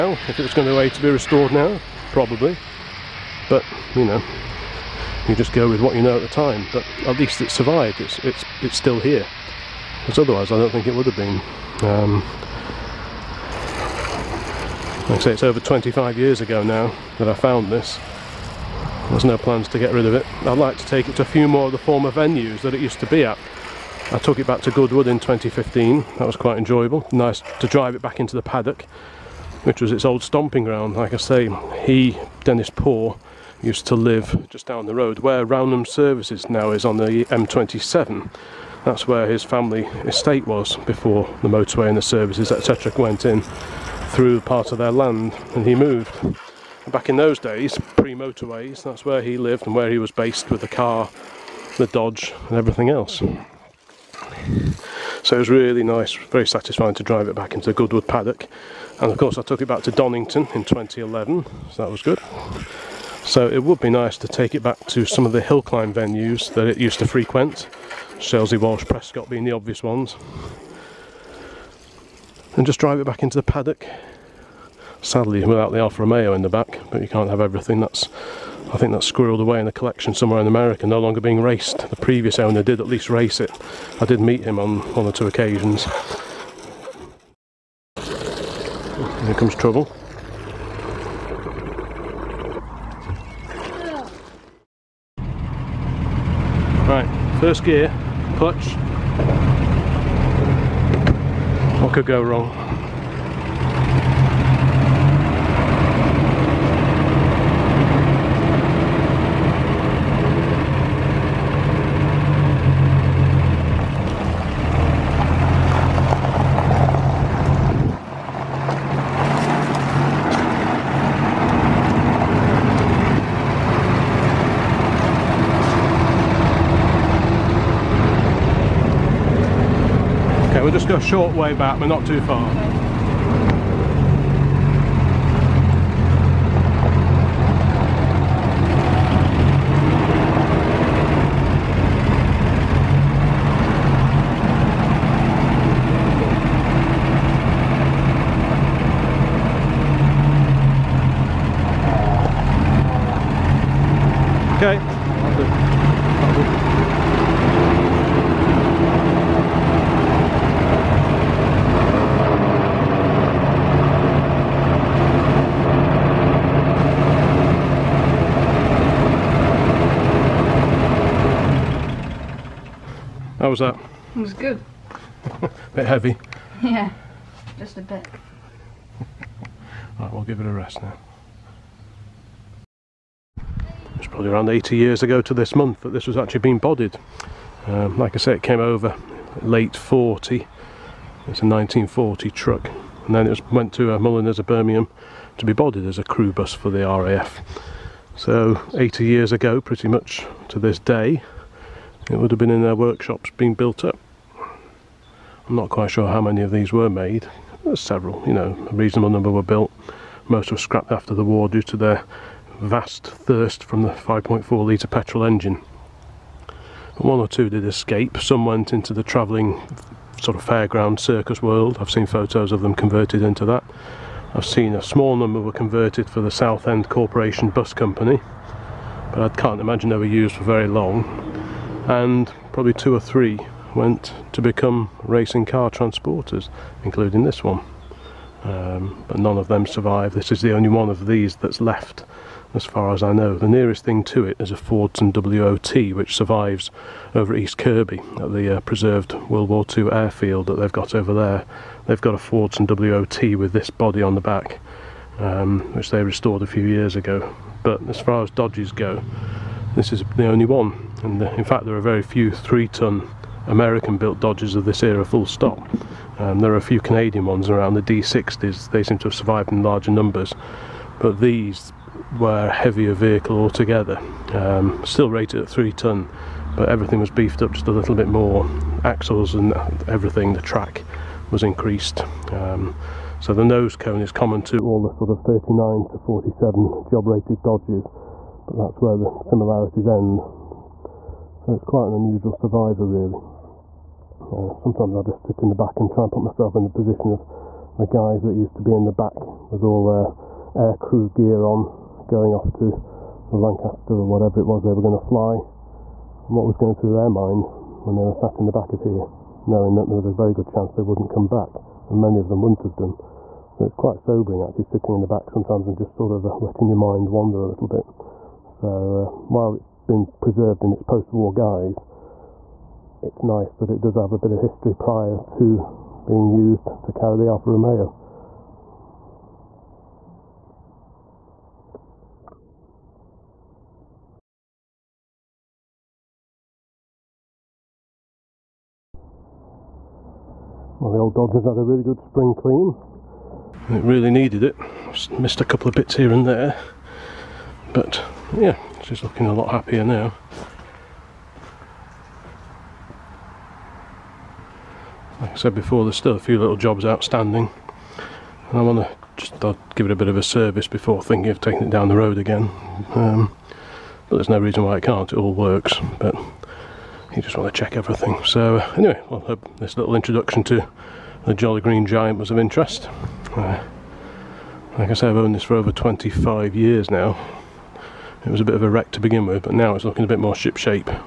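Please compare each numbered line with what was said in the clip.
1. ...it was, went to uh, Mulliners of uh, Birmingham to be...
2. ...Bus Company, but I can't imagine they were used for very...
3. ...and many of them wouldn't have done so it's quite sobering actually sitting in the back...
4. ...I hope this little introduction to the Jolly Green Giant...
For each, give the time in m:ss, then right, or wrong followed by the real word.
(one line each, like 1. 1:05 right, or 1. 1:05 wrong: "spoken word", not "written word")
1. 3:13 right
2. 3:47 right
3. 5:11 right
4. 6:09 right.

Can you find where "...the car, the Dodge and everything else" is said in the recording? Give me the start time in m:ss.
0:50.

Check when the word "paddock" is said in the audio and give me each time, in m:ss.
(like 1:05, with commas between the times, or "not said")
0:28, 0:58, 1:13.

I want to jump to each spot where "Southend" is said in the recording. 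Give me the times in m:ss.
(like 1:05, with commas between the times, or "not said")
3:46.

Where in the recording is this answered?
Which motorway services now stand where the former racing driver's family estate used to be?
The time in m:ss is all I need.
0:35.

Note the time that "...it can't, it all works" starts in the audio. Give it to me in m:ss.
6:04.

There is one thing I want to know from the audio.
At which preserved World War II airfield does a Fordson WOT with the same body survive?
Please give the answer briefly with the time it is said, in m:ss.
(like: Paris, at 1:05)
East Kirkby, at 4:07.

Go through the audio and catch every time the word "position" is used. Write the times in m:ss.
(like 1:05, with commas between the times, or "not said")
4:56.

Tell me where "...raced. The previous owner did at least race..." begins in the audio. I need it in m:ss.
1:21.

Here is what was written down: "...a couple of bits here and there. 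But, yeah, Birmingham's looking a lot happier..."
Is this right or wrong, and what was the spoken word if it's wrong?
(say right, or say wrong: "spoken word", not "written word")
wrong: "She", not "Birmingham".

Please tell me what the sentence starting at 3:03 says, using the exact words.
It's probably around 80 years ago to this month that this was actually being bodied.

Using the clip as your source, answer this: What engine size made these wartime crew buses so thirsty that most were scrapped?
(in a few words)
5.4 litre.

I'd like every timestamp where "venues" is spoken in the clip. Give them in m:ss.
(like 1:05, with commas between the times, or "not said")
0:22, 1:05.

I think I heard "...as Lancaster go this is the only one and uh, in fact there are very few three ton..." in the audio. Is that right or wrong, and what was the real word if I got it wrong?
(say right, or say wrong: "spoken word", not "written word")
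wrong: "Dodges", not "Lancaster".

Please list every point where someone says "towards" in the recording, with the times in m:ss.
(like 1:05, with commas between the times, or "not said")
not said.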